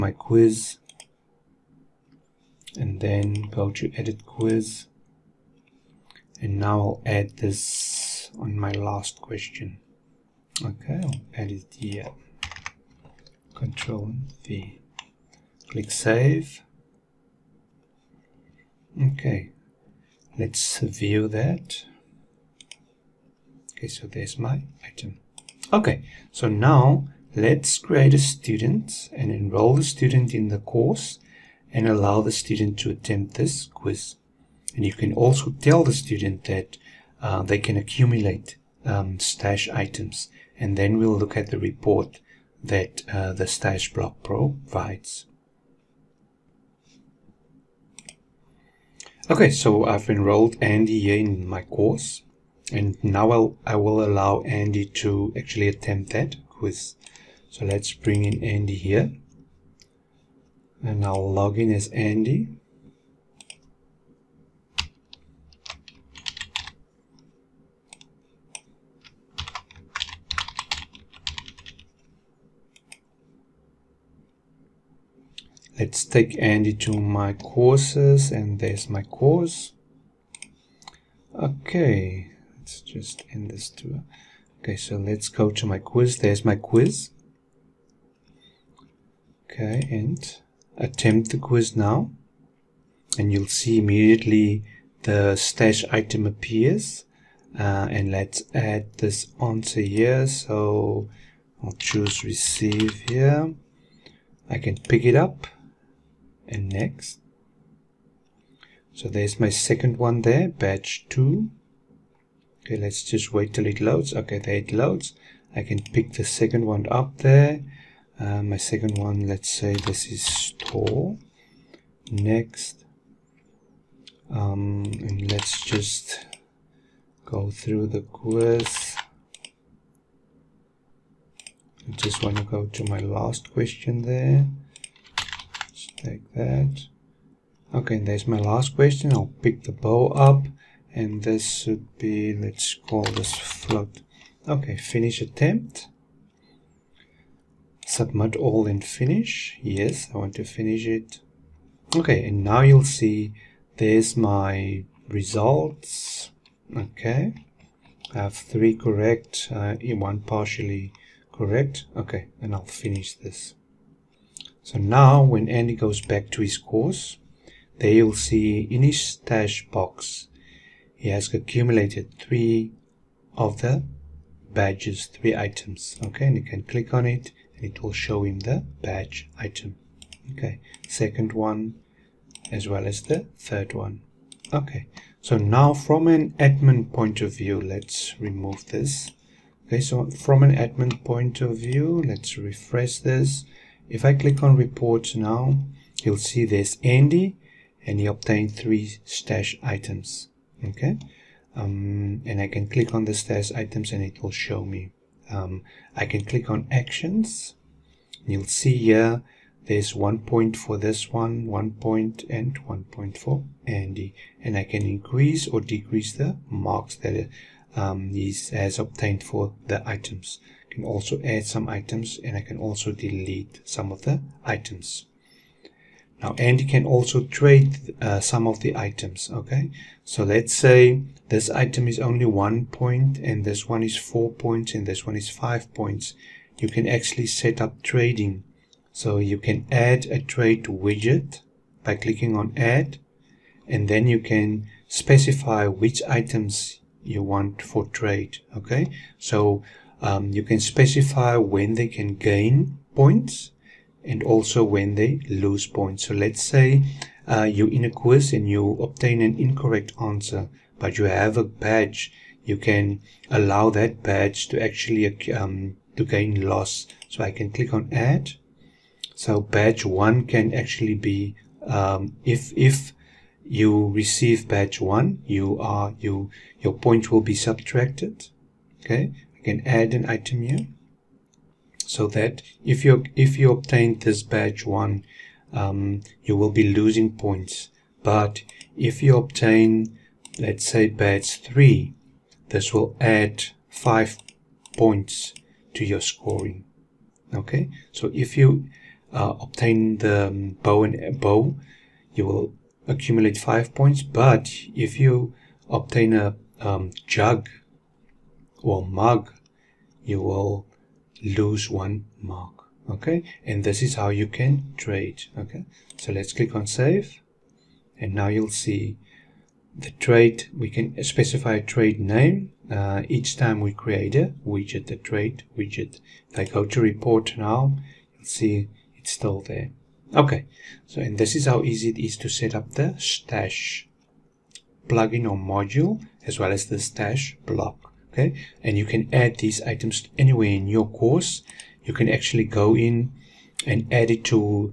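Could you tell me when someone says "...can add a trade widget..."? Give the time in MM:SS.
03:59.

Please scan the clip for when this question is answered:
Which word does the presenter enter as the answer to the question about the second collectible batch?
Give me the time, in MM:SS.
02:00.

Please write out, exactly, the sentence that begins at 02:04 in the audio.
Um, and let's just go through the quiz.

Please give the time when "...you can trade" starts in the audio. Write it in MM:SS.
05:14.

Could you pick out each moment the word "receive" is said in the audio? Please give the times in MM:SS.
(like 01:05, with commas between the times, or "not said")
01:42, 04:33.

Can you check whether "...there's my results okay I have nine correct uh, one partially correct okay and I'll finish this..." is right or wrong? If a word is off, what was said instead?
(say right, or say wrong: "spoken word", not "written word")
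wrong: "three", not "nine".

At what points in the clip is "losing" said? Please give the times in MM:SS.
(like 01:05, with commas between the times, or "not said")
04:46.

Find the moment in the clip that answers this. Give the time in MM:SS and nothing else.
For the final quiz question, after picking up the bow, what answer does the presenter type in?
02:23.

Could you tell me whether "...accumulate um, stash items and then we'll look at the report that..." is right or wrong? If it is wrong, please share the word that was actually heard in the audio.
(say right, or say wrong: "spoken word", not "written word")
right.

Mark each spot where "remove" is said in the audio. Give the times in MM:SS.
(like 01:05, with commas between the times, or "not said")
03:08.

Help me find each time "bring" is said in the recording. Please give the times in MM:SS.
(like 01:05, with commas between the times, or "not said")
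00:57.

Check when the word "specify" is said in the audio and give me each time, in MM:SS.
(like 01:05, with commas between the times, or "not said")
04:04, 04:10, 05:21.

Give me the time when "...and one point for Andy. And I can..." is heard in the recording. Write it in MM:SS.
03:32.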